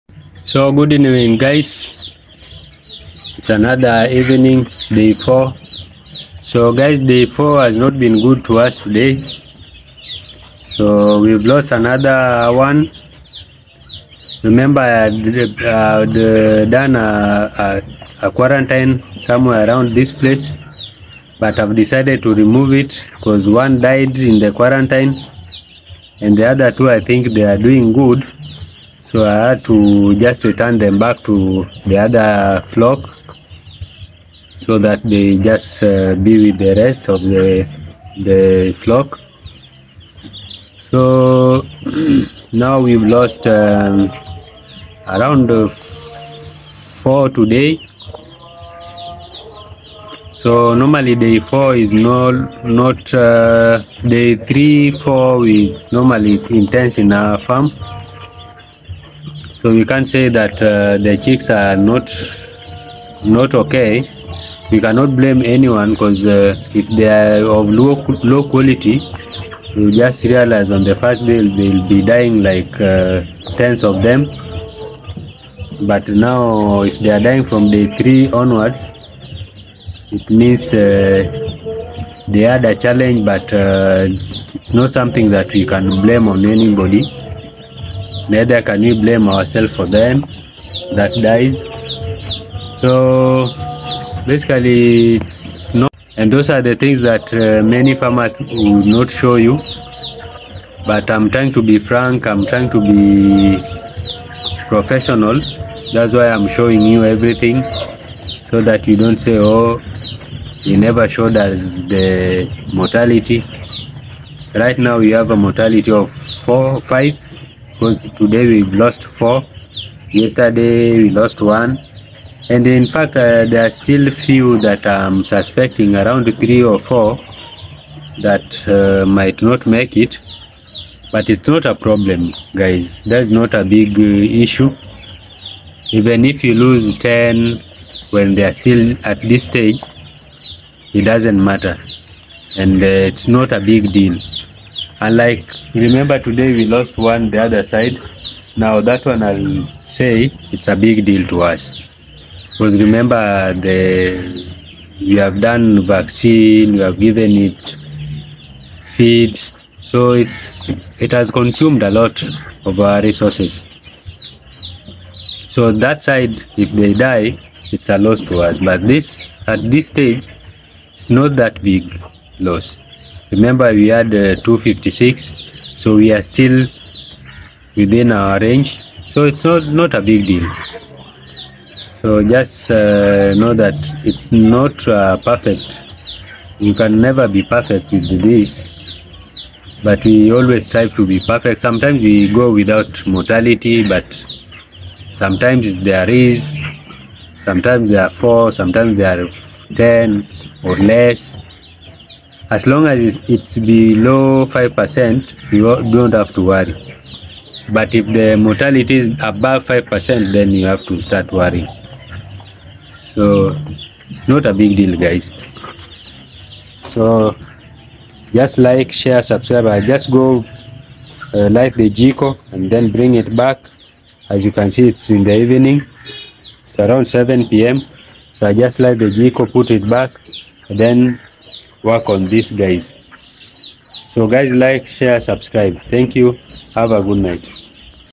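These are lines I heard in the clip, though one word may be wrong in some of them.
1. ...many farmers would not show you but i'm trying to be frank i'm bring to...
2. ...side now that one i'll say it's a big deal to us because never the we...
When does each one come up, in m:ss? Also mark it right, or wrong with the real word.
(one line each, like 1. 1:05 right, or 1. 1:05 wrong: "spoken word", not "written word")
1. 1:37 wrong: "trying", not "bring"
2. 2:27 wrong: "remember", not "never".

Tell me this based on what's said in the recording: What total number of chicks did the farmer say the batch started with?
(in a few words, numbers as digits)
256.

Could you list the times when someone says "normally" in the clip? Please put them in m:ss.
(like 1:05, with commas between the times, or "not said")
0:50, 0:55.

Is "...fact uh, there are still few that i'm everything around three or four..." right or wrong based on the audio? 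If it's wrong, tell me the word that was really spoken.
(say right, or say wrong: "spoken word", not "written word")
wrong: "suspecting", not "everything".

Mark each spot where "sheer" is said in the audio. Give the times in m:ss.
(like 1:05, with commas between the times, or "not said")
not said.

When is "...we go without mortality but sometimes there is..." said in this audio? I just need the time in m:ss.
3:12.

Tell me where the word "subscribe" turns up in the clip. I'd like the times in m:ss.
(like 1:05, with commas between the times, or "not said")
3:39, 3:55.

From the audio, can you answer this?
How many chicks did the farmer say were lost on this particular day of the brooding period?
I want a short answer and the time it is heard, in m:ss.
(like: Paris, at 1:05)
4, at 0:42.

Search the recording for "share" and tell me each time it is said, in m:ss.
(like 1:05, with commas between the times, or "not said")
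3:38, 3:54.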